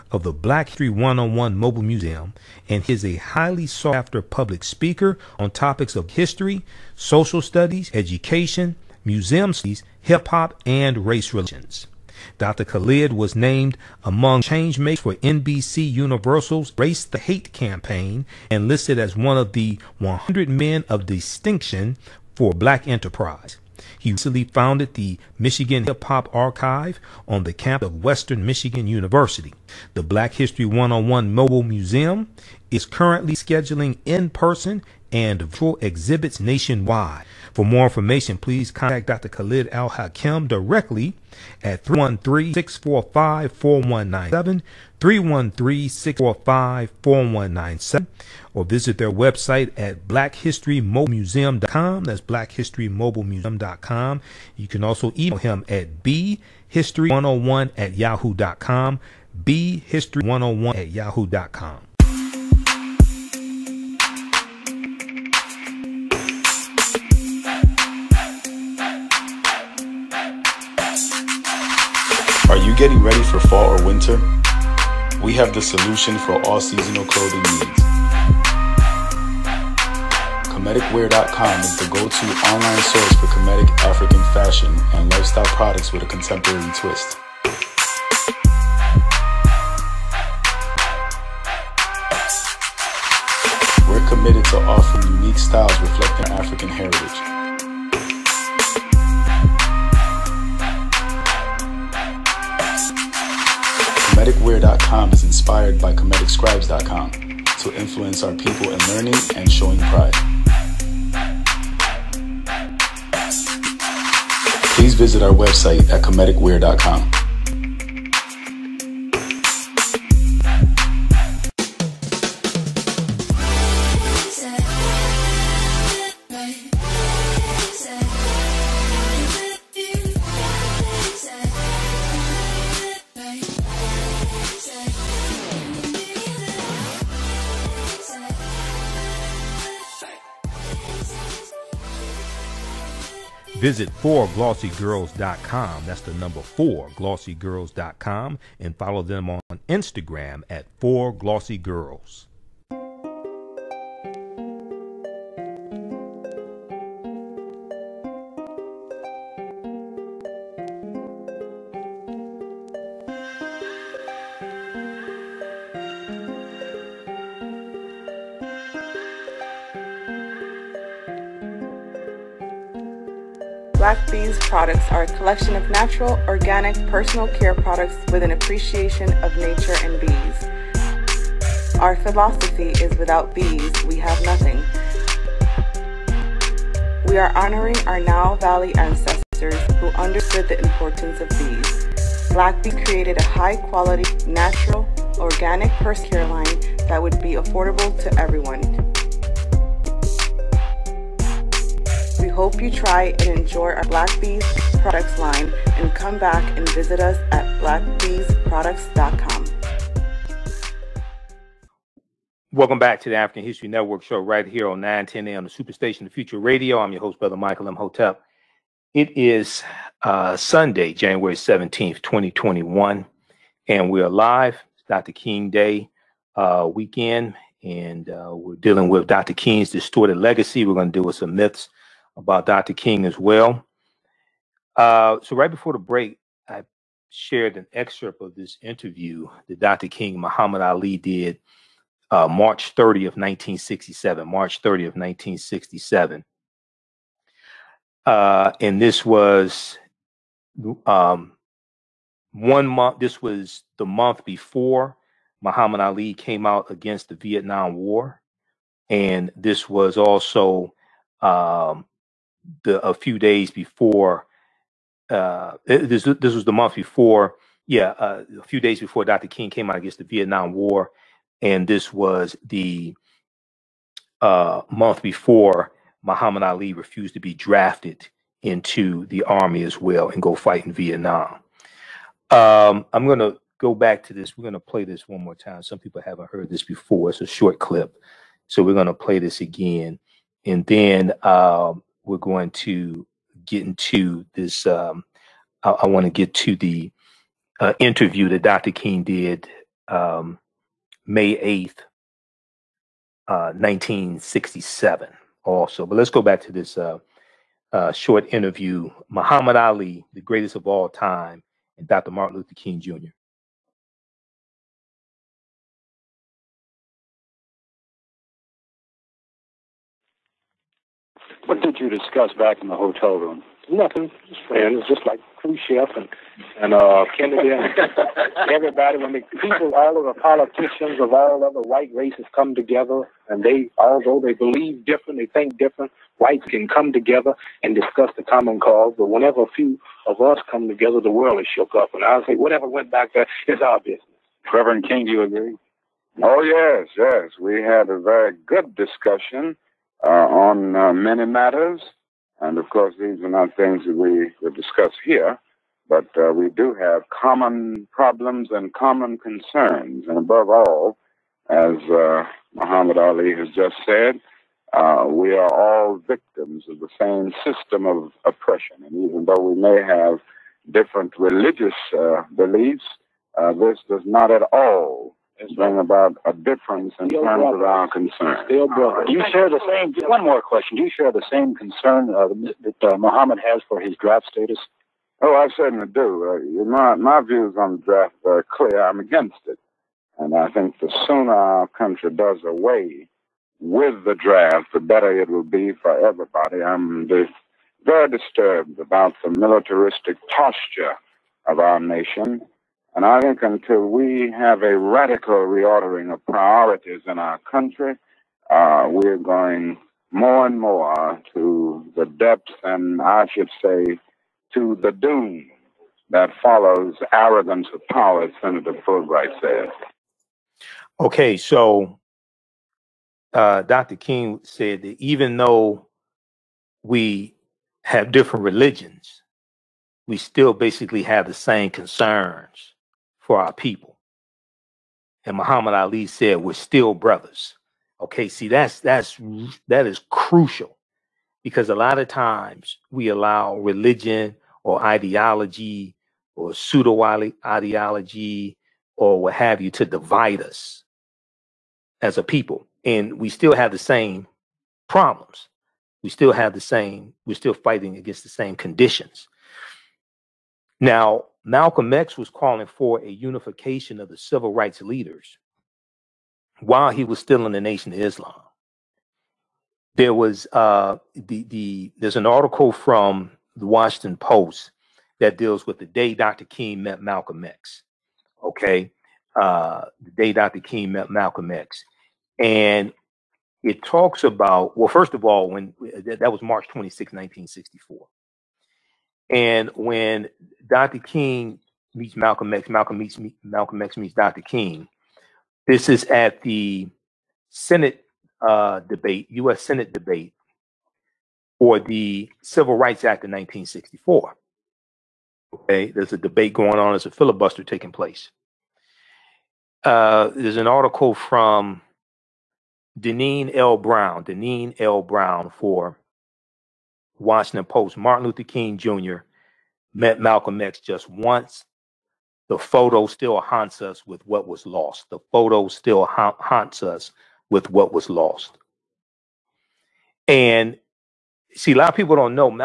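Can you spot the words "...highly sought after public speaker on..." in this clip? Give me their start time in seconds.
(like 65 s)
3 s.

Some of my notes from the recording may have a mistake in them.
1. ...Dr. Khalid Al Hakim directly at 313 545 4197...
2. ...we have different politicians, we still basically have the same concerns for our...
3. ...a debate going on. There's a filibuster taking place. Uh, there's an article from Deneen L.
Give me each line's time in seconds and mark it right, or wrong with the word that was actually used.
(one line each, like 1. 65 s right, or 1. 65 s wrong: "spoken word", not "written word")
1. 39 s wrong: "645", not "545"
2. 426 s wrong: "religions", not "politicians"
3. 506 s right.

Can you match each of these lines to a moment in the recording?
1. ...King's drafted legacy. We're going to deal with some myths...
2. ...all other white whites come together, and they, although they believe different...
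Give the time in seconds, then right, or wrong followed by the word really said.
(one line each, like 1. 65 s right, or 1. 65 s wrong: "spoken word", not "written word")
1. 229 s wrong: "distorted", not "drafted"
2. 331 s wrong: "races", not "whites".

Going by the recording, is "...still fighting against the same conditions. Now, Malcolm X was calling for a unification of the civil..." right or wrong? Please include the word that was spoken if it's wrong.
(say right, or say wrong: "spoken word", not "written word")
right.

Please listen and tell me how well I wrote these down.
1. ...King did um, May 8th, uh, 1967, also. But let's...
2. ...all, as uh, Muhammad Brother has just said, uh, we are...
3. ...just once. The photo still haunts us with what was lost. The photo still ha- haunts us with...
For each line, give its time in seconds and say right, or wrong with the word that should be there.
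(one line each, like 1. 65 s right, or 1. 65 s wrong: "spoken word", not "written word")
1. 298 s right
2. 360 s wrong: "Ali", not "Brother"
3. 520 s right.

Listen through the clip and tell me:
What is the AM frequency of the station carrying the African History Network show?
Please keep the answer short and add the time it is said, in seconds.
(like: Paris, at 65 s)
910, at 214 s.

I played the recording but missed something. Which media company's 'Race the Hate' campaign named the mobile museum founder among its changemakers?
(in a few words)
NBC Universal.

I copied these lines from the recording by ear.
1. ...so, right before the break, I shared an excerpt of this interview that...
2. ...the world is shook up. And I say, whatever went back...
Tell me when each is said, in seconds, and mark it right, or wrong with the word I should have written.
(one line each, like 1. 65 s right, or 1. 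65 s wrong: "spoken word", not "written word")
1. 235 s right
2. 340 s right.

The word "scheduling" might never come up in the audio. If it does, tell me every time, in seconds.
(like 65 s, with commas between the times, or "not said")
33 s.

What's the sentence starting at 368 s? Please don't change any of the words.
And even though we may have different religious uh, beliefs, this does not at all that's bring right.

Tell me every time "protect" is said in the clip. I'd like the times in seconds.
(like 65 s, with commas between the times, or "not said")
not said.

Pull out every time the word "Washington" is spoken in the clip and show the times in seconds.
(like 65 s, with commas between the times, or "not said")
473 s, 517 s.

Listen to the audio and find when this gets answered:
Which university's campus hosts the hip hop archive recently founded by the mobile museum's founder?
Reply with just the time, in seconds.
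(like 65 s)
28 s.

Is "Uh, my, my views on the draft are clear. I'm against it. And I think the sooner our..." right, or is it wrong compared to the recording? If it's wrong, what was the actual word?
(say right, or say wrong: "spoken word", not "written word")
right.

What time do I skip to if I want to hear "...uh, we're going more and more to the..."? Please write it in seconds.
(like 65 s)
408 s.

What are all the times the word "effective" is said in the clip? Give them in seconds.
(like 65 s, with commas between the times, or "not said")
not said.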